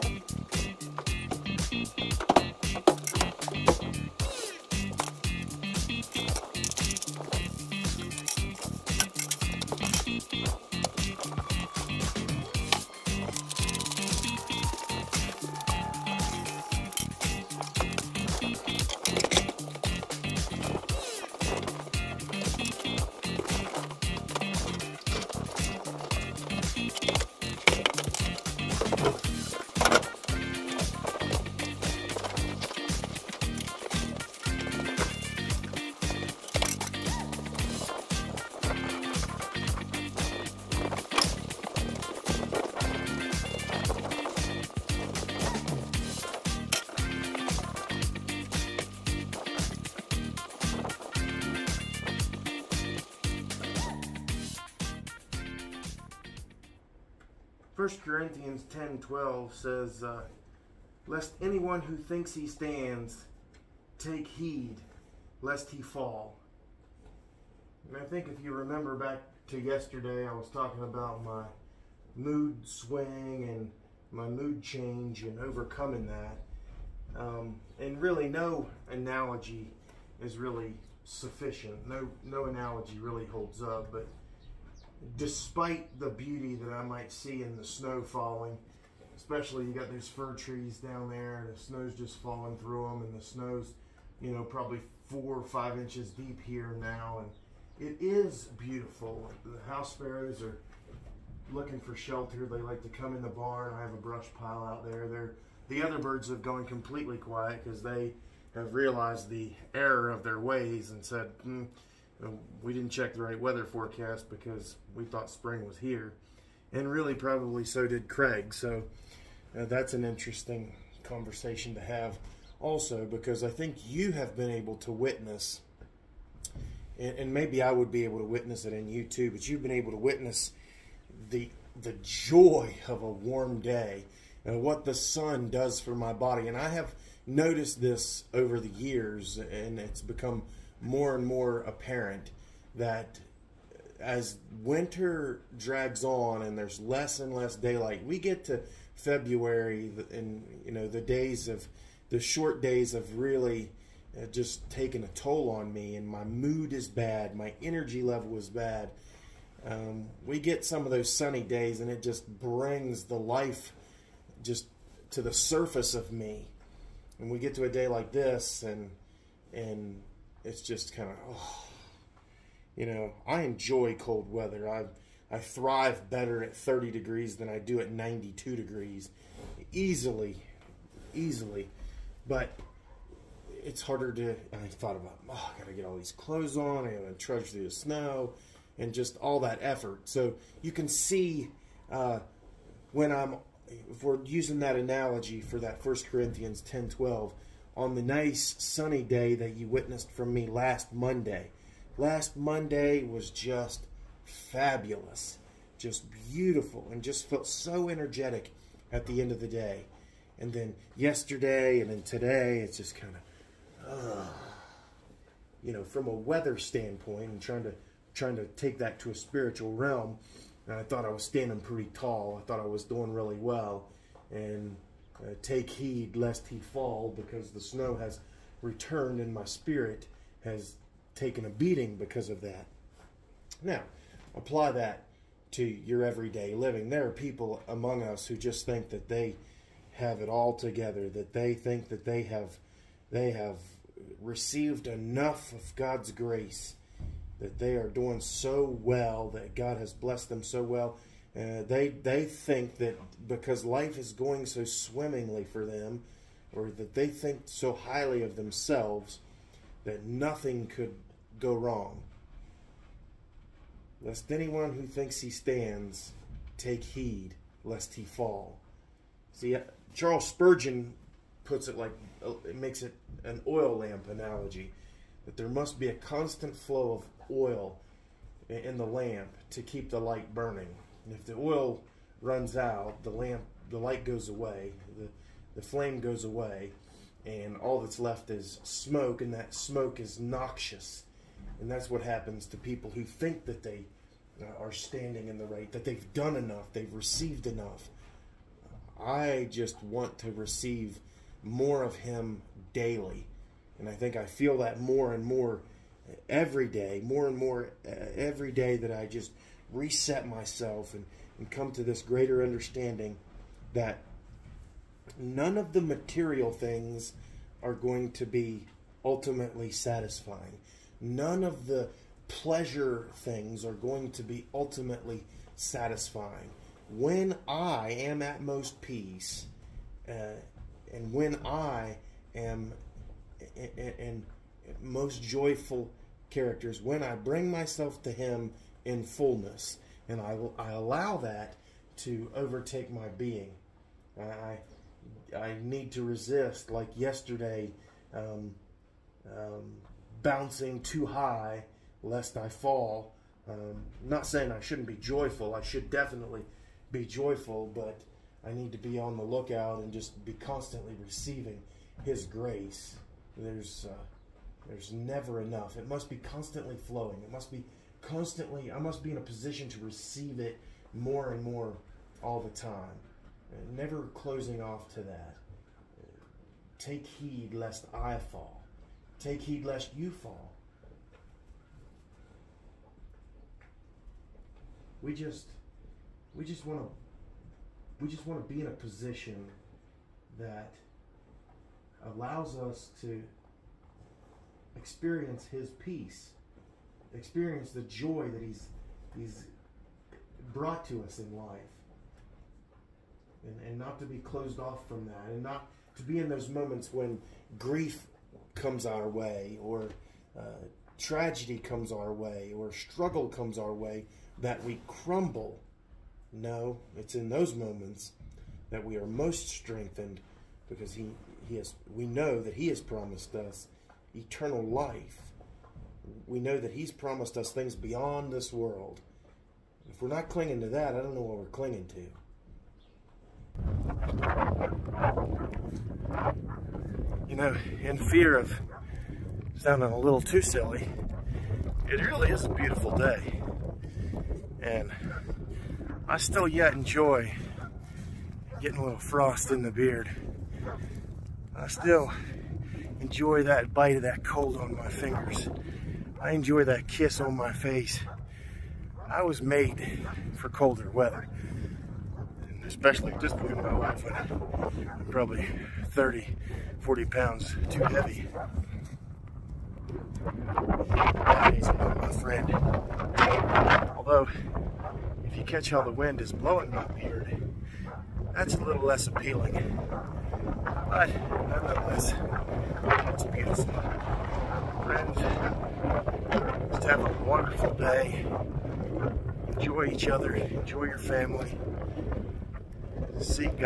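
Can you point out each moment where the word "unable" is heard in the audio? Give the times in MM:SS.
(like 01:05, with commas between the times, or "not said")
not said.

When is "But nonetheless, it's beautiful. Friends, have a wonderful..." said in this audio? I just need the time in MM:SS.
08:00.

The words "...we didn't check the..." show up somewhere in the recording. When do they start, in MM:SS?
01:52.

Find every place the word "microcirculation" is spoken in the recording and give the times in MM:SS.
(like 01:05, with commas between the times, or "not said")
not said.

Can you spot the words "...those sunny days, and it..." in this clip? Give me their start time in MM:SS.
02:40.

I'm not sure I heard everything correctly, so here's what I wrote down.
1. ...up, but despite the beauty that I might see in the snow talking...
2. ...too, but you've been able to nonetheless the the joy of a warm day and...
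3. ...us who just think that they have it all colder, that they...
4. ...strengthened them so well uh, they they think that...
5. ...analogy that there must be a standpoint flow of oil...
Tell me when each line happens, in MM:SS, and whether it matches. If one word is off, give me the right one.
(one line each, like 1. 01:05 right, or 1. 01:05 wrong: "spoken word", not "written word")
1. 01:23 wrong: "falling", not "talking"
2. 02:09 wrong: "witness", not "nonetheless"
3. 03:58 wrong: "together", not "colder"
4. 04:09 wrong: "blessed", not "strengthened"
5. 04:34 wrong: "constant", not "standpoint".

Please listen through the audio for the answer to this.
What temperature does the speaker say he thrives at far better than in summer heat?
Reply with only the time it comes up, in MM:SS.
02:56.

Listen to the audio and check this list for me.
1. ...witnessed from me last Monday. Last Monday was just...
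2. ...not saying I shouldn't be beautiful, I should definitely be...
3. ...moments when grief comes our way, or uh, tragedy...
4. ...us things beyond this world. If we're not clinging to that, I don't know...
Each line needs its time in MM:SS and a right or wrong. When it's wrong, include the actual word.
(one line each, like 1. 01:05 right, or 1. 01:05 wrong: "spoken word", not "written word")
1. 03:19 right
2. 05:54 wrong: "joyful", not "beautiful"
3. 06:46 right
4. 07:07 right.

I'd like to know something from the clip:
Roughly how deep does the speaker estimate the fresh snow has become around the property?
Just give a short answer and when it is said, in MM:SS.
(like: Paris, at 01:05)
4 or 5 inches, at 01:35.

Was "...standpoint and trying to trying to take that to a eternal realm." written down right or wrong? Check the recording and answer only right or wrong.
wrong.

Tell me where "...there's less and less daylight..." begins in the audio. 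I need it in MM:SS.
02:26.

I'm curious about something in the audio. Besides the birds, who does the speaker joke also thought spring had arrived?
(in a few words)
Craig.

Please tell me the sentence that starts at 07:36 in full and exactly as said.
I enjoy that kiss on my face.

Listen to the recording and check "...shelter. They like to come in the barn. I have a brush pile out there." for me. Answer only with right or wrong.
right.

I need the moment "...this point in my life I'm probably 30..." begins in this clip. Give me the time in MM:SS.
07:43.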